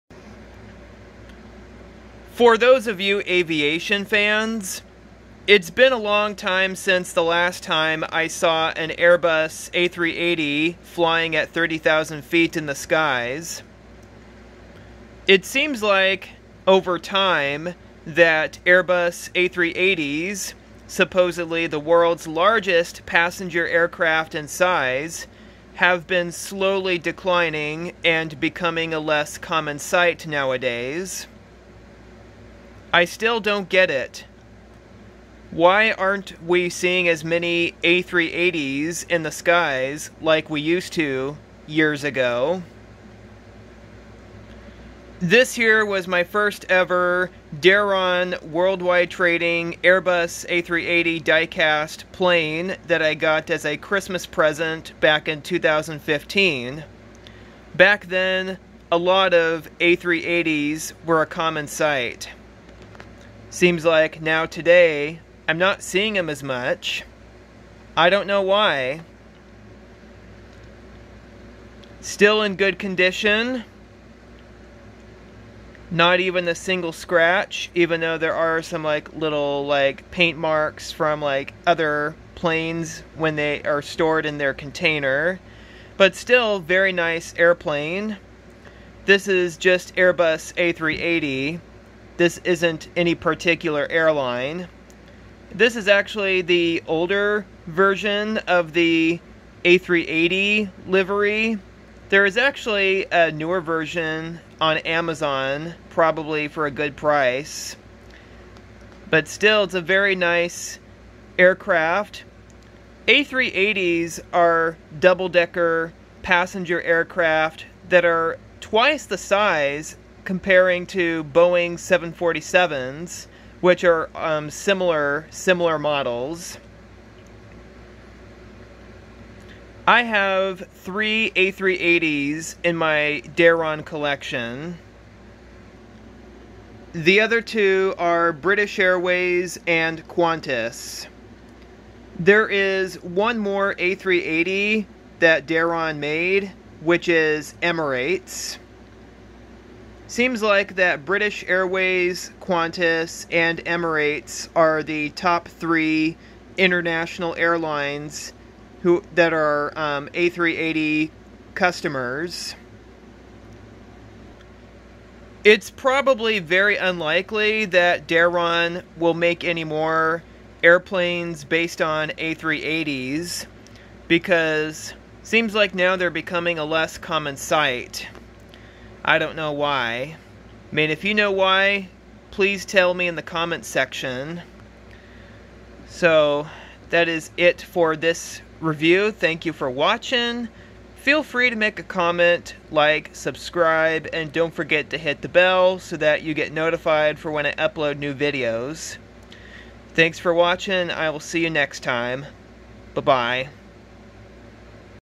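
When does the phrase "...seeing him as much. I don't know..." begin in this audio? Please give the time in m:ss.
1:05.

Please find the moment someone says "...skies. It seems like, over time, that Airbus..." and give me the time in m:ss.
0:12.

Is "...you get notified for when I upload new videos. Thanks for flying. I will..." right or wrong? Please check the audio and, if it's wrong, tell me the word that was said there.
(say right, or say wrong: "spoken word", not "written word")
wrong: "watching", not "flying".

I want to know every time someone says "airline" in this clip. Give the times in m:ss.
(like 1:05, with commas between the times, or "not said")
1:33, 2:37.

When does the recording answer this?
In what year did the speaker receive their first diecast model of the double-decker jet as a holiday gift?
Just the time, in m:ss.
0:55.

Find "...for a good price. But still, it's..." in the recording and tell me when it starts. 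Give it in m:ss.
1:46.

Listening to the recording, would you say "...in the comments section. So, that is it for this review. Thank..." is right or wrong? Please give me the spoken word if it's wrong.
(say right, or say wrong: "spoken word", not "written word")
right.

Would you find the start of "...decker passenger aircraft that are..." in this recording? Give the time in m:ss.
1:55.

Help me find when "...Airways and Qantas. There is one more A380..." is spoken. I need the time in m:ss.
2:18.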